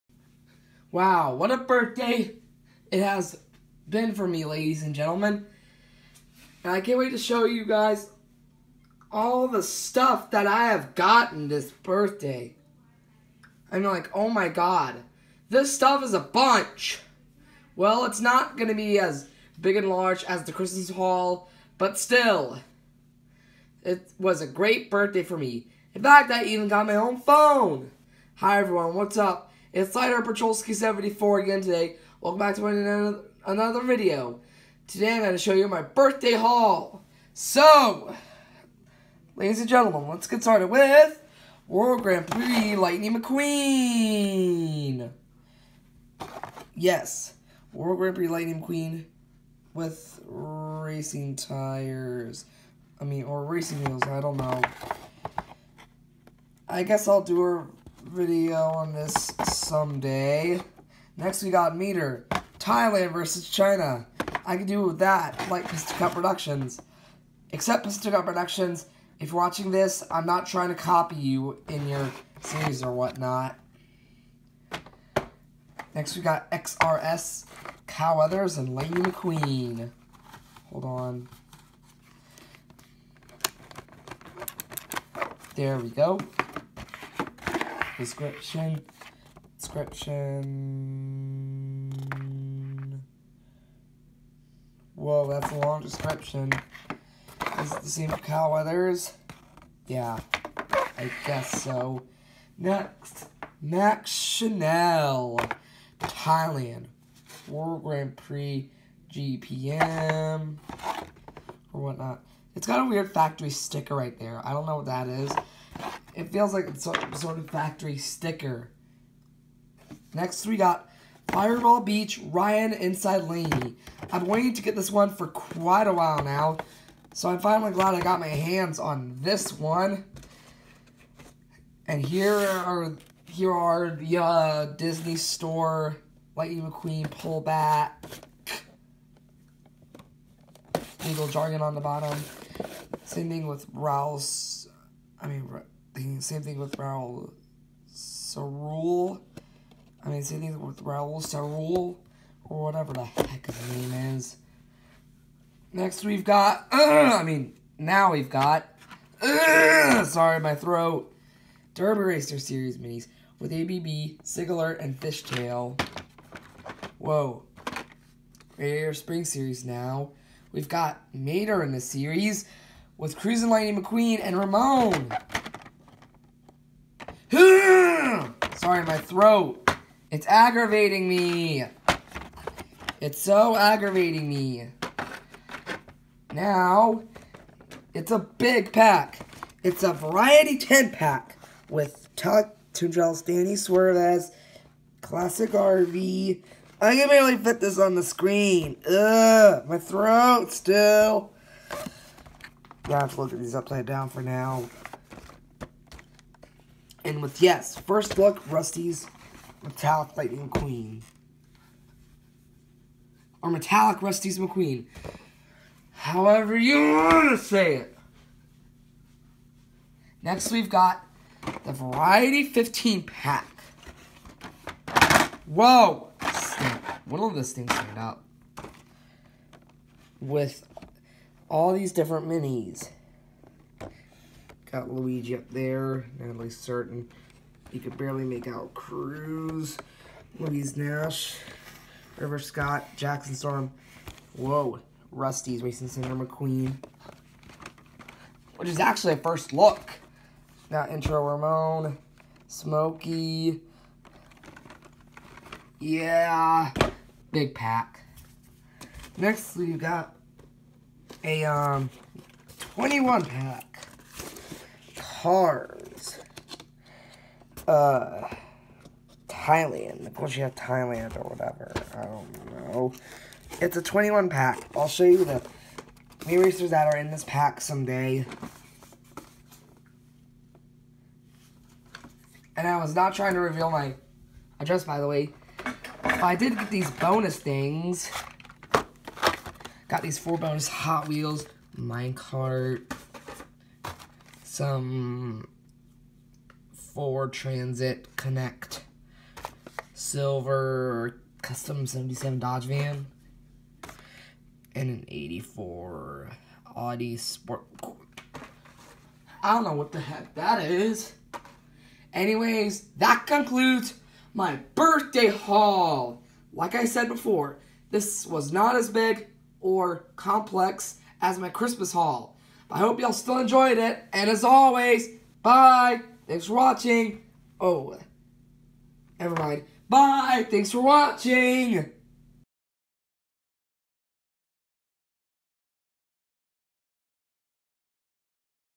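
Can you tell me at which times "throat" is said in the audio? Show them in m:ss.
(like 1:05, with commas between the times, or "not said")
2:40, 2:58, 3:19.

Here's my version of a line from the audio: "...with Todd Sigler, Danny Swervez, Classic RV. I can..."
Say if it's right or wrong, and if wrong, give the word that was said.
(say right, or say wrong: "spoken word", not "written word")
wrong: "Tunjels", not "Sigler".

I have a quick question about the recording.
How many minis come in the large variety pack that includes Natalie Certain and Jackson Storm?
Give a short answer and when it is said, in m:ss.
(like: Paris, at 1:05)
15, at 3:42.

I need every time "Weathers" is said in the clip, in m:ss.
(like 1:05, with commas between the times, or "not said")
1:18, 1:38.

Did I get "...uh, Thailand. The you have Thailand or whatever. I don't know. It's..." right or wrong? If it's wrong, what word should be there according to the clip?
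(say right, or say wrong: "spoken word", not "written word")
right.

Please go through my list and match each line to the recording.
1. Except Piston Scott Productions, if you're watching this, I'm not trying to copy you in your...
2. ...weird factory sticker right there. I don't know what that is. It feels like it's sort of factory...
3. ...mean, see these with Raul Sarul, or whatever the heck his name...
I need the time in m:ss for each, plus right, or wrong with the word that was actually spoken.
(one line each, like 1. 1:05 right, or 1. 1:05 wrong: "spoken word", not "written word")
1. 1:07 wrong: "Cup", not "Scott"
2. 1:52 right
3. 2:30 right.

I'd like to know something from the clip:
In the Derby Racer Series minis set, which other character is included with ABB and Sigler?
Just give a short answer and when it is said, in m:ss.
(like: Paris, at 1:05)
Fishtail, at 2:44.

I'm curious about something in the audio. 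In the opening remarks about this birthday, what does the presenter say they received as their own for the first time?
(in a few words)
Phone.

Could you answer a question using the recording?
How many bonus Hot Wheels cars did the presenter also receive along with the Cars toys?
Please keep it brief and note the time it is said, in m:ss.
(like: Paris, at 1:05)
4, at 4:50.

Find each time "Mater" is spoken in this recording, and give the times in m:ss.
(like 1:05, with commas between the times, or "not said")
1:01, 2:51.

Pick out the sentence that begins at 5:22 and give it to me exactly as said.
I hope y'all still enjoyed it.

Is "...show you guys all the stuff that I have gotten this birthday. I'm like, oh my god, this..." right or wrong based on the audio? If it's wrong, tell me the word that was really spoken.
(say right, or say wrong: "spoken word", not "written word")
right.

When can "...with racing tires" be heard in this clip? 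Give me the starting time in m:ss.
0:49.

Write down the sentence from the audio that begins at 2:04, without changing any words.
I've been waiting to get this one for quite a while now.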